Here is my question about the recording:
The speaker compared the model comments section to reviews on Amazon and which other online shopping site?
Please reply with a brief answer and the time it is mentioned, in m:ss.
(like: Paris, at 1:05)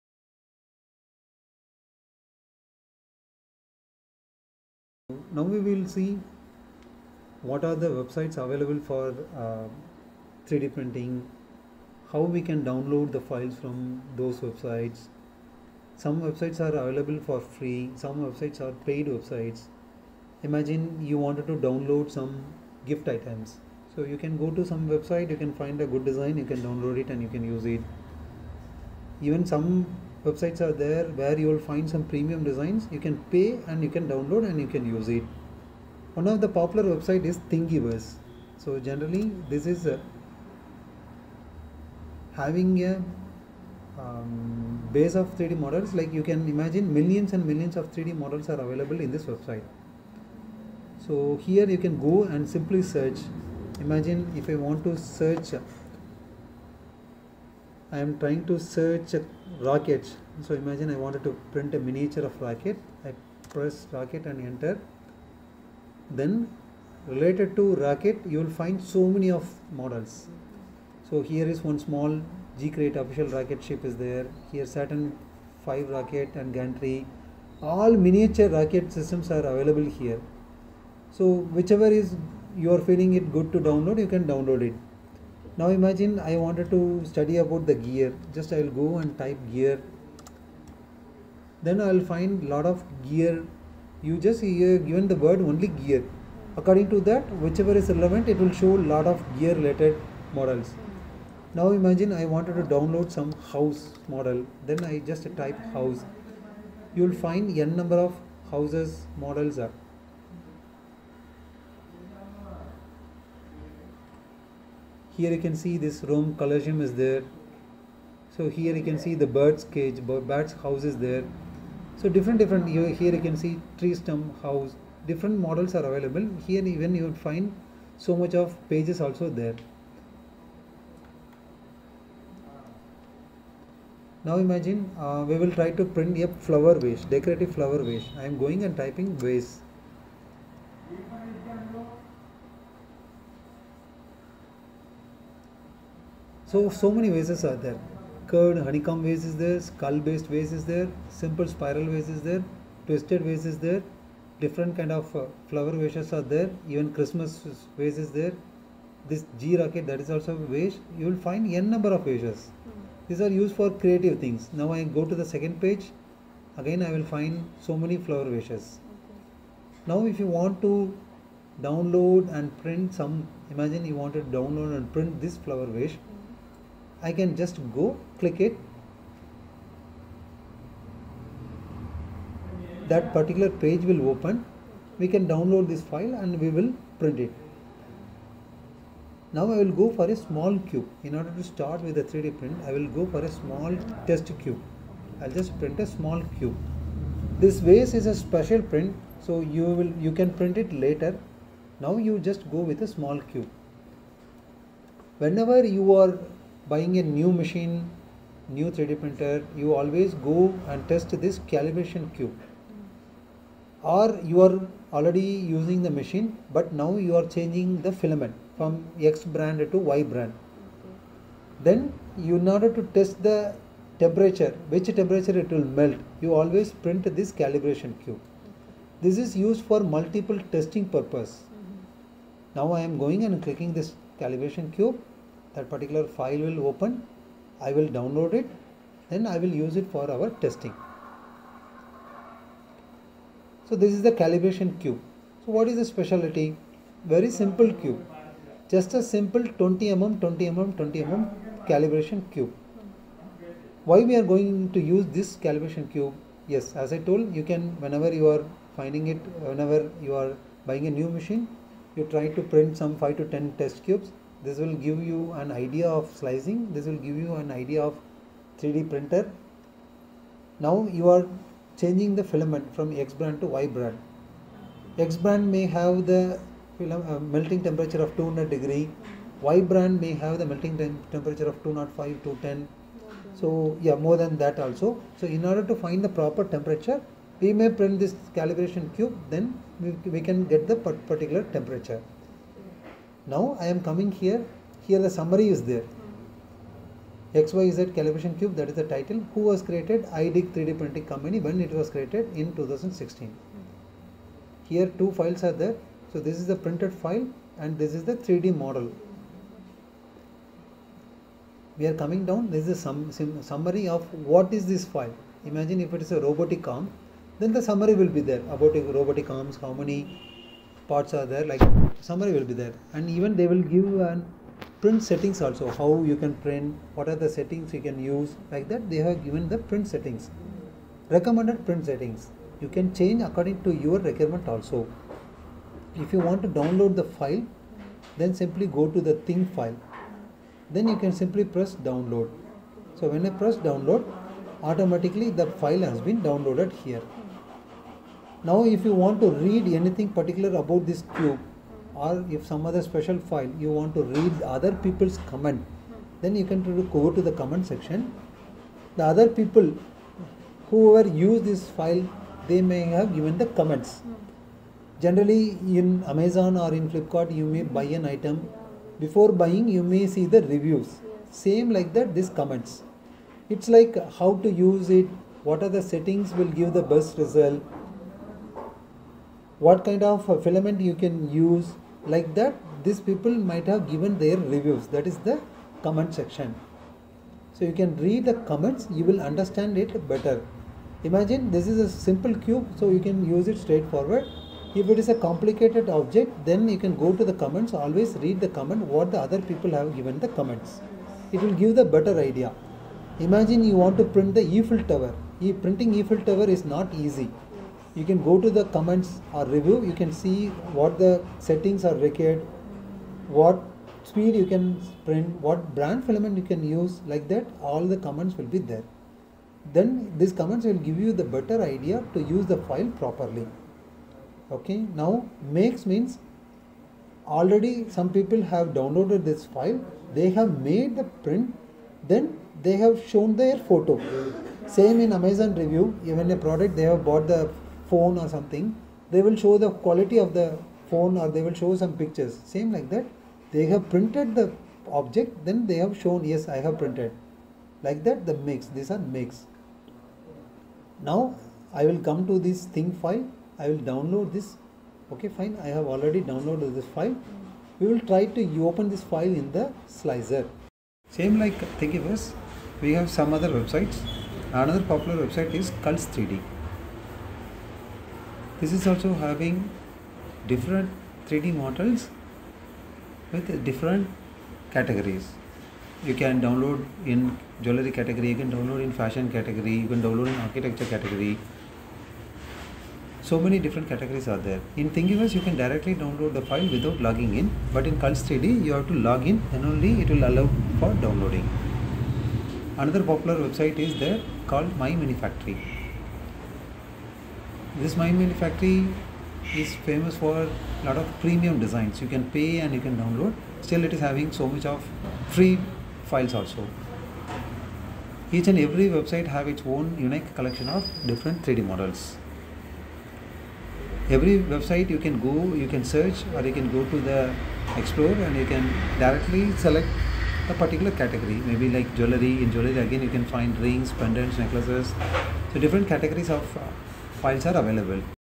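Flipkart, at 6:06.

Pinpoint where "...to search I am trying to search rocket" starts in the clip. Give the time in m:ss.
0:54.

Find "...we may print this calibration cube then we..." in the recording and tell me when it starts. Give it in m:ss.
4:47.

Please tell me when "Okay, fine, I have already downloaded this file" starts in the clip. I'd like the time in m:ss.
7:35.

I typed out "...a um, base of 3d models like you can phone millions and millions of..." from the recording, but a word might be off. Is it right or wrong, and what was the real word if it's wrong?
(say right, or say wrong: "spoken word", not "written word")
wrong: "imagine", not "phone".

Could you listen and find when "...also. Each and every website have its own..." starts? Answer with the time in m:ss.
8:26.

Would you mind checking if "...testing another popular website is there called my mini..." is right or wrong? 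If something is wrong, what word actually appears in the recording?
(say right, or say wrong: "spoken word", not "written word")
wrong: "downloading", not "testing".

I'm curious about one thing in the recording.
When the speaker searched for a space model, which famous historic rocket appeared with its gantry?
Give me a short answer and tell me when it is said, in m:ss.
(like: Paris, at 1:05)
Saturn 5, at 1:14.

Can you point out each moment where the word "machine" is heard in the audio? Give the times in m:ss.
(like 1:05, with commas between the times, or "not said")
3:27, 3:35, 4:21.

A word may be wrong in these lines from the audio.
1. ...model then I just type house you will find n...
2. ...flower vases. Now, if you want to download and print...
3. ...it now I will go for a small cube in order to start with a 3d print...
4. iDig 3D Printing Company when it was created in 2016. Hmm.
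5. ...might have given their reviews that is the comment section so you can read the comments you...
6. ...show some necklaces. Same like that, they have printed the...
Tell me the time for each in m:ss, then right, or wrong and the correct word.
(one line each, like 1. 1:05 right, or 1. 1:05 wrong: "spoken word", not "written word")
1. 1:44 right
2. 2:47 right
3. 3:07 right
4. 5:00 right
5. 6:23 right
6. 7:21 wrong: "pictures", not "necklaces".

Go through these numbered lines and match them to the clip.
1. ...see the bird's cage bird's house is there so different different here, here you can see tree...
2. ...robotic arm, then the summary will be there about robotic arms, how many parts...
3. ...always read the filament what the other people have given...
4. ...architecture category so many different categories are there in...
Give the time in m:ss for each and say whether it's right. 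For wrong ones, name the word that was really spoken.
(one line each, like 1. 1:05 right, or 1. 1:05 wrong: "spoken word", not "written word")
1. 1:59 right
2. 5:16 right
3. 6:37 wrong: "comment", not "filament"
4. 8:00 right.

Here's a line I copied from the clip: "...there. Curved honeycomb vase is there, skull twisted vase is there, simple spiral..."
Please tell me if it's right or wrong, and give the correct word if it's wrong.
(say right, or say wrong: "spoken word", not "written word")
wrong: "based", not "twisted".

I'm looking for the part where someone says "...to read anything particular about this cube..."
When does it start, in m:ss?
5:49.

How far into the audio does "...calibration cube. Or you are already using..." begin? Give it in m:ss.
3:31.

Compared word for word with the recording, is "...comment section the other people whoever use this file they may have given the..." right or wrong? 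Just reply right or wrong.
right.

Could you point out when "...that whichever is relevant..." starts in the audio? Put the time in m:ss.
1:37.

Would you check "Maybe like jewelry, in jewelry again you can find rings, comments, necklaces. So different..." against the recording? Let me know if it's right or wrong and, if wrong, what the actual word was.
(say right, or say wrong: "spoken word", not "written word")
wrong: "pendants", not "comments".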